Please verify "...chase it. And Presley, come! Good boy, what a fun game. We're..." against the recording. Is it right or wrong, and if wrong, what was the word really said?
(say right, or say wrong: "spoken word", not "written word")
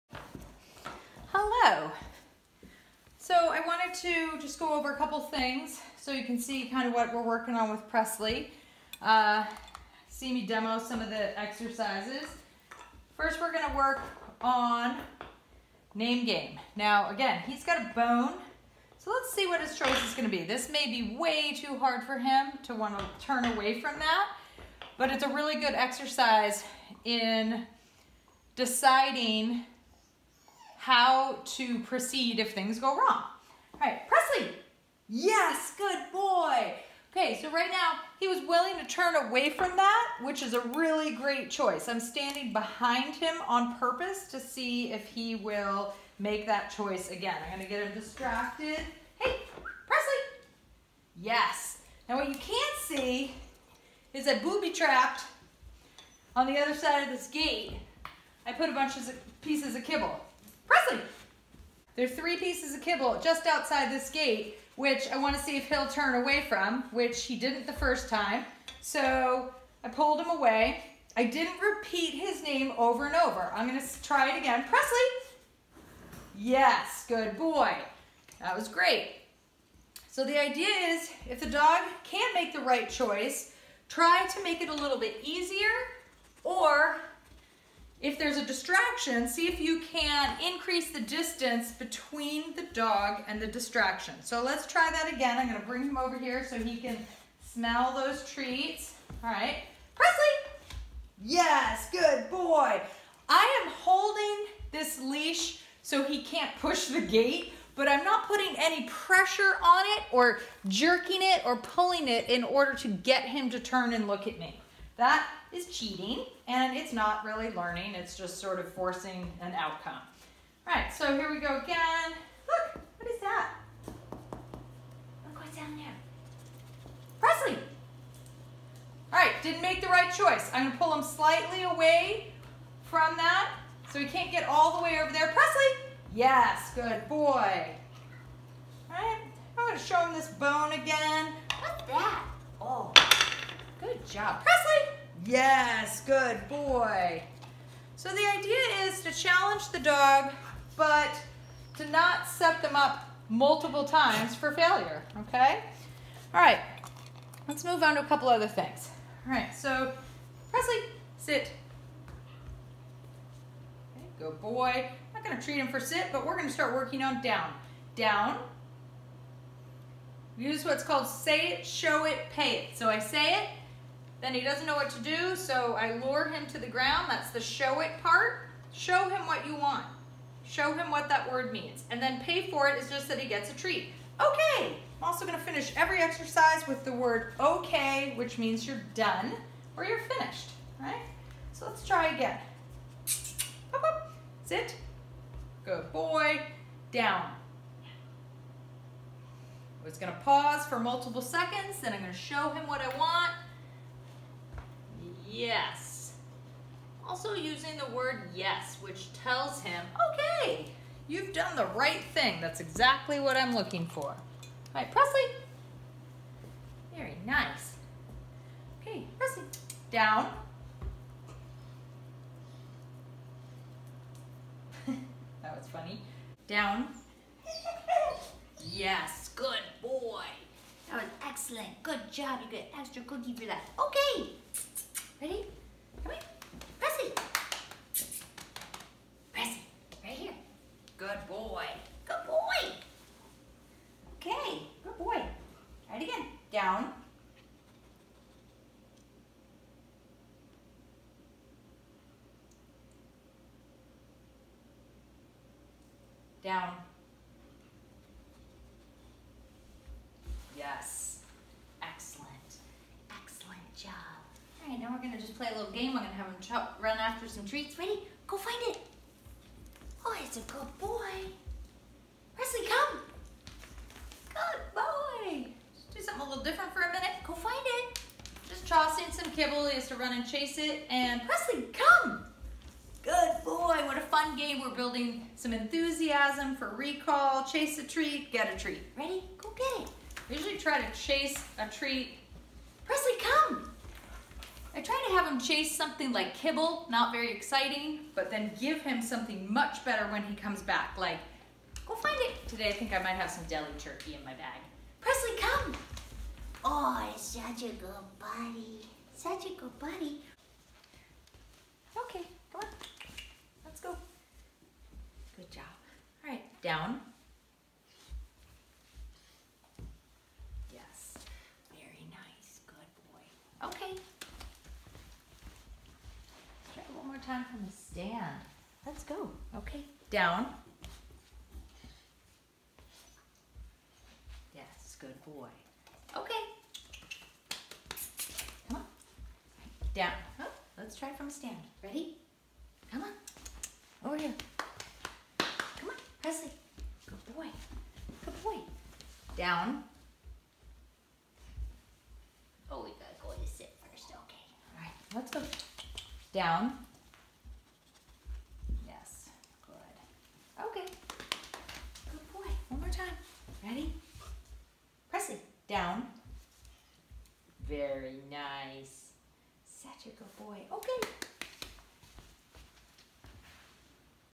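right.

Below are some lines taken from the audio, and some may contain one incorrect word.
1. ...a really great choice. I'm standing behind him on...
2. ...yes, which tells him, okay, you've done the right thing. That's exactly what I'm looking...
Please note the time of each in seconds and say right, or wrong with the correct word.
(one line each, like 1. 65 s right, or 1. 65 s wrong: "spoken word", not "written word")
1. 40 s right
2. 208 s right.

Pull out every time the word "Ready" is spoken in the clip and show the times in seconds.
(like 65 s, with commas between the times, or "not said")
267 s, 288 s, 341 s, 363 s.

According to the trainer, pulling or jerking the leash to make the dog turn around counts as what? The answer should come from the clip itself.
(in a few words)
cheating.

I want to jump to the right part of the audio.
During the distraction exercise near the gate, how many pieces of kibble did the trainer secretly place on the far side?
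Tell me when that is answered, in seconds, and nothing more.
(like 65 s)
62 s.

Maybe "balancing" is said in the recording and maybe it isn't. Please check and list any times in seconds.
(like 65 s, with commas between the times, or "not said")
not said.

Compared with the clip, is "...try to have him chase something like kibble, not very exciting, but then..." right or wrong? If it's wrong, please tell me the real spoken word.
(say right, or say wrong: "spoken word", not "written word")
right.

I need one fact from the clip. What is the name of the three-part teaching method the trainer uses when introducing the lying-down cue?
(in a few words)
say it, show it, pay it.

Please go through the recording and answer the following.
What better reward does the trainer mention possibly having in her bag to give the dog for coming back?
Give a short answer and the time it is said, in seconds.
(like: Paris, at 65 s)
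deli turkey, at 303 s.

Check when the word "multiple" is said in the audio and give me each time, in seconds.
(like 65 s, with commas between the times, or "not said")
153 s, 200 s.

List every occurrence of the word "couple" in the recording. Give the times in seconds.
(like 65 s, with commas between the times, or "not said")
4 s, 158 s.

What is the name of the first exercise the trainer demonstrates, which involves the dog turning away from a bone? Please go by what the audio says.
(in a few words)
name game.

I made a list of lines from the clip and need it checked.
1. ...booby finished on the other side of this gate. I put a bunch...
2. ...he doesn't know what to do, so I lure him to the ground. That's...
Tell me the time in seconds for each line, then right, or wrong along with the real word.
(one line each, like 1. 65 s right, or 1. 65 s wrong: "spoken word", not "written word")
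1. 54 s wrong: "trapped", not "finished"
2. 174 s right.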